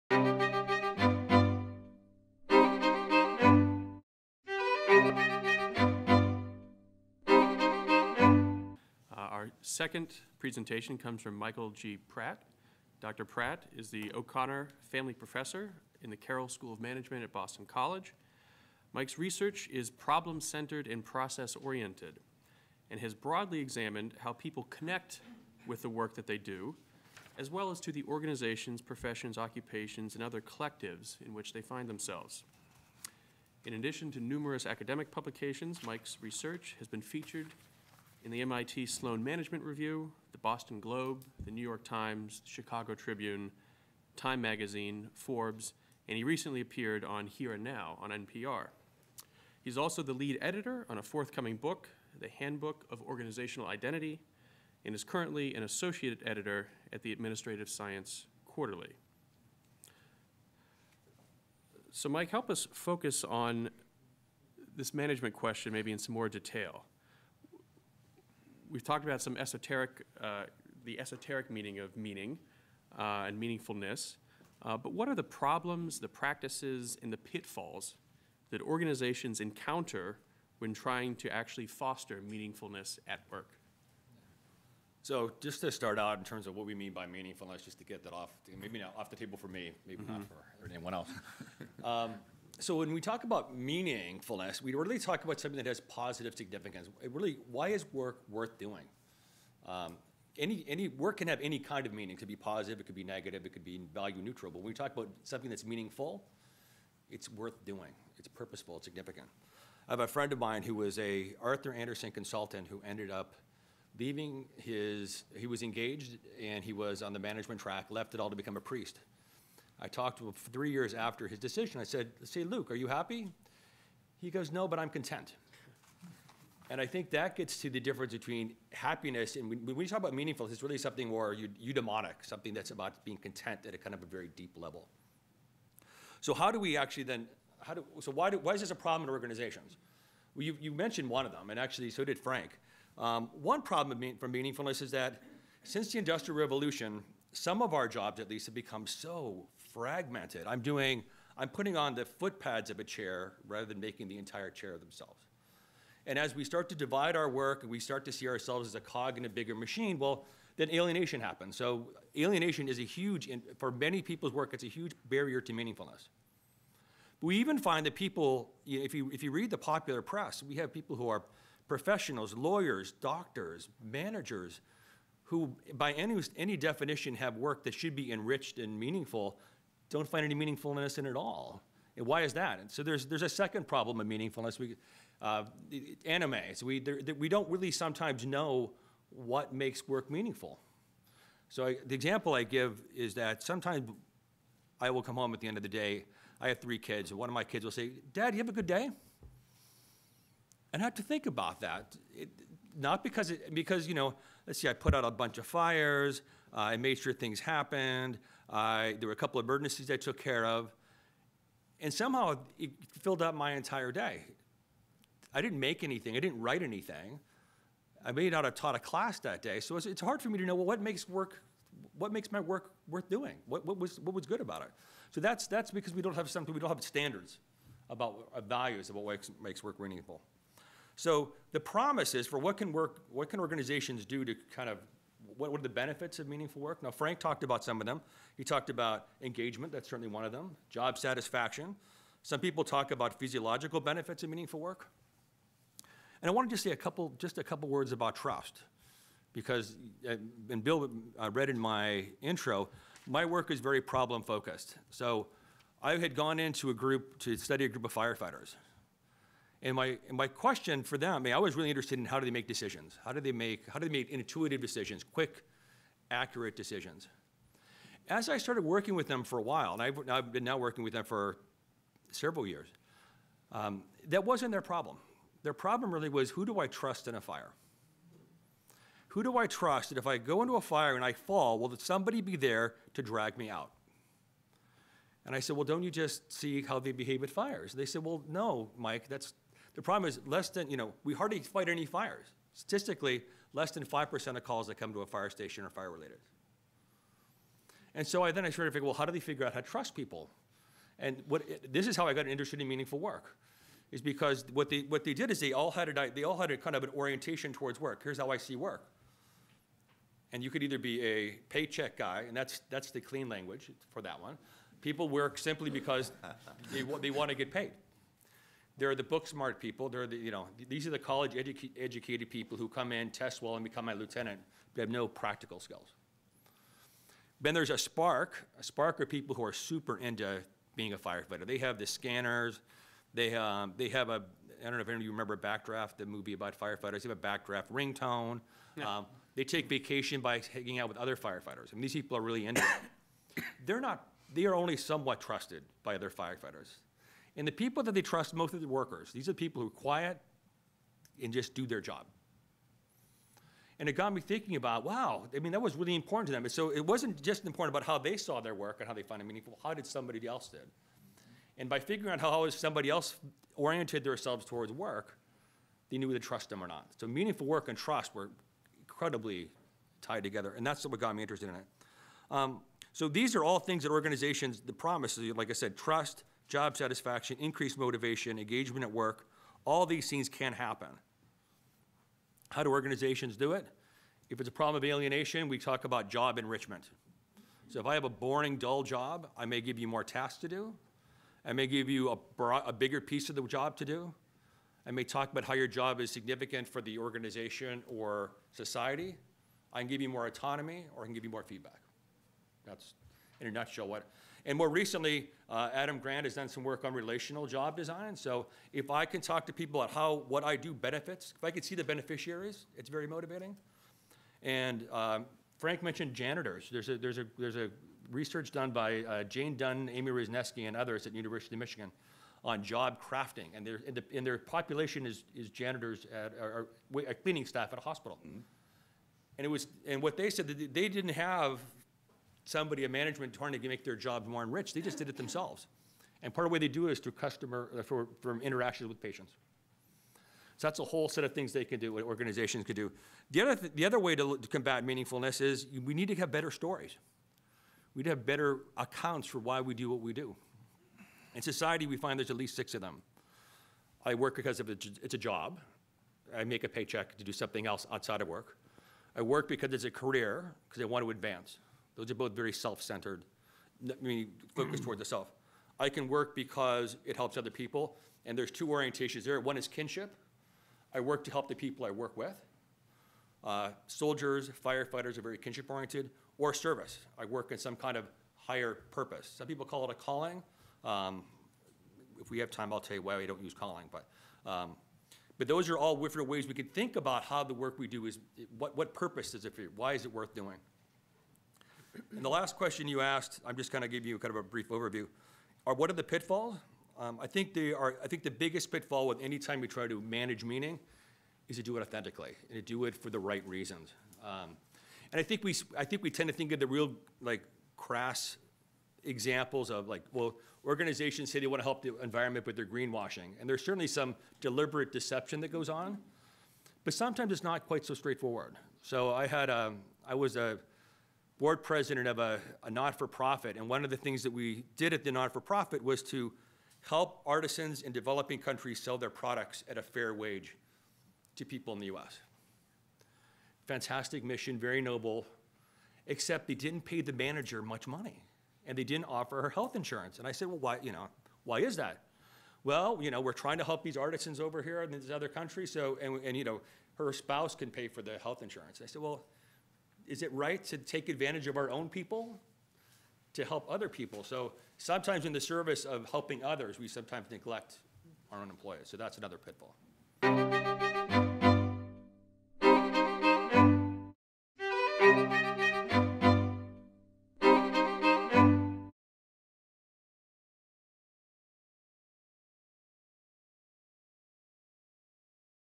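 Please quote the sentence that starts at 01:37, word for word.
It really, why is work worth doing?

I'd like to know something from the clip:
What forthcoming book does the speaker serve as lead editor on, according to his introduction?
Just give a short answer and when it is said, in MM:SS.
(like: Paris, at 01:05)
The Handbook of Organizational Identity, at 00:52.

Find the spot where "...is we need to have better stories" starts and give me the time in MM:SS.
07:25.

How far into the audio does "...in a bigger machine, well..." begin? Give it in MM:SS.
02:39.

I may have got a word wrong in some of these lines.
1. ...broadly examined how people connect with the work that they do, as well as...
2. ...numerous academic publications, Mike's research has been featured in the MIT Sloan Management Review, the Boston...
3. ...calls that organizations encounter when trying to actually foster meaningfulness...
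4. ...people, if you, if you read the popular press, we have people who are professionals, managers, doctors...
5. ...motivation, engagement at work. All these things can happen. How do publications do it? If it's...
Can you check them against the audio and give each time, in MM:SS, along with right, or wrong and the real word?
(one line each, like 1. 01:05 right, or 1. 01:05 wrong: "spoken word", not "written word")
1. 00:23 right
2. 00:34 right
3. 01:17 wrong: "pitfalls", not "calls"
4. 02:47 wrong: "lawyers", not "managers"
5. 06:17 wrong: "organizations", not "publications".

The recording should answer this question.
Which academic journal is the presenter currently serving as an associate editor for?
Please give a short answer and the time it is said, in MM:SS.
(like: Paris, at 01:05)
Administrative Science Quarterly, at 00:57.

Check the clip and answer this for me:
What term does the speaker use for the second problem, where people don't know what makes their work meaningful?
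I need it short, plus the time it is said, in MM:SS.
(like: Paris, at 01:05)
Anomie, at 03:06.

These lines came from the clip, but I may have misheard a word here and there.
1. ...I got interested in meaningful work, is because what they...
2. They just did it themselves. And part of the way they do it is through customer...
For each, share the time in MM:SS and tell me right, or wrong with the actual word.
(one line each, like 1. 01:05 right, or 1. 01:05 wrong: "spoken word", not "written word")
1. 05:02 right
2. 07:14 right.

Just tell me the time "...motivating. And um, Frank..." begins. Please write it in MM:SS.
06:53.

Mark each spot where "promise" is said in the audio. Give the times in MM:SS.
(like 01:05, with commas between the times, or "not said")
03:51, 06:14.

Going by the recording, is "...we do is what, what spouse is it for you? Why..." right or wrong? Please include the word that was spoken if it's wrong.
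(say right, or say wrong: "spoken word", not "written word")
wrong: "purpose", not "spouse".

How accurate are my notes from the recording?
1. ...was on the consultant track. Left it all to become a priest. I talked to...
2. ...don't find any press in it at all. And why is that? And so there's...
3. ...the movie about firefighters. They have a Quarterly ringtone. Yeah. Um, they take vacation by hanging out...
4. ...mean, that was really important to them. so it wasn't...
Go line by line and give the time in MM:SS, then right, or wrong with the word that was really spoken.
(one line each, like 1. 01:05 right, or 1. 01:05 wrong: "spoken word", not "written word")
1. 01:56 wrong: "management", not "consultant"
2. 02:59 wrong: "meaningfulness", not "press"
3. 05:35 wrong: "Backdraft", not "Quarterly"
4. 05:55 right.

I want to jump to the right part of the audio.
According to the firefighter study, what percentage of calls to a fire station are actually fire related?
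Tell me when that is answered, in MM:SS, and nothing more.
04:53.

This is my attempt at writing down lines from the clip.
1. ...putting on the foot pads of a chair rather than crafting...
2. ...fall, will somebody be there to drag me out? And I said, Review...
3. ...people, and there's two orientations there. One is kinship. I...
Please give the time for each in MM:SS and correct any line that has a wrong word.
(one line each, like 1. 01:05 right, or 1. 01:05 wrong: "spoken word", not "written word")
1. 02:31 wrong: "making", not "crafting"
2. 04:41 wrong: "Well", not "Review"
3. 07:47 right.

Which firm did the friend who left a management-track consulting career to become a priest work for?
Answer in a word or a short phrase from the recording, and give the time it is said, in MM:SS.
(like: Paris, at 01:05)
Arthur Andersen, at 01:51.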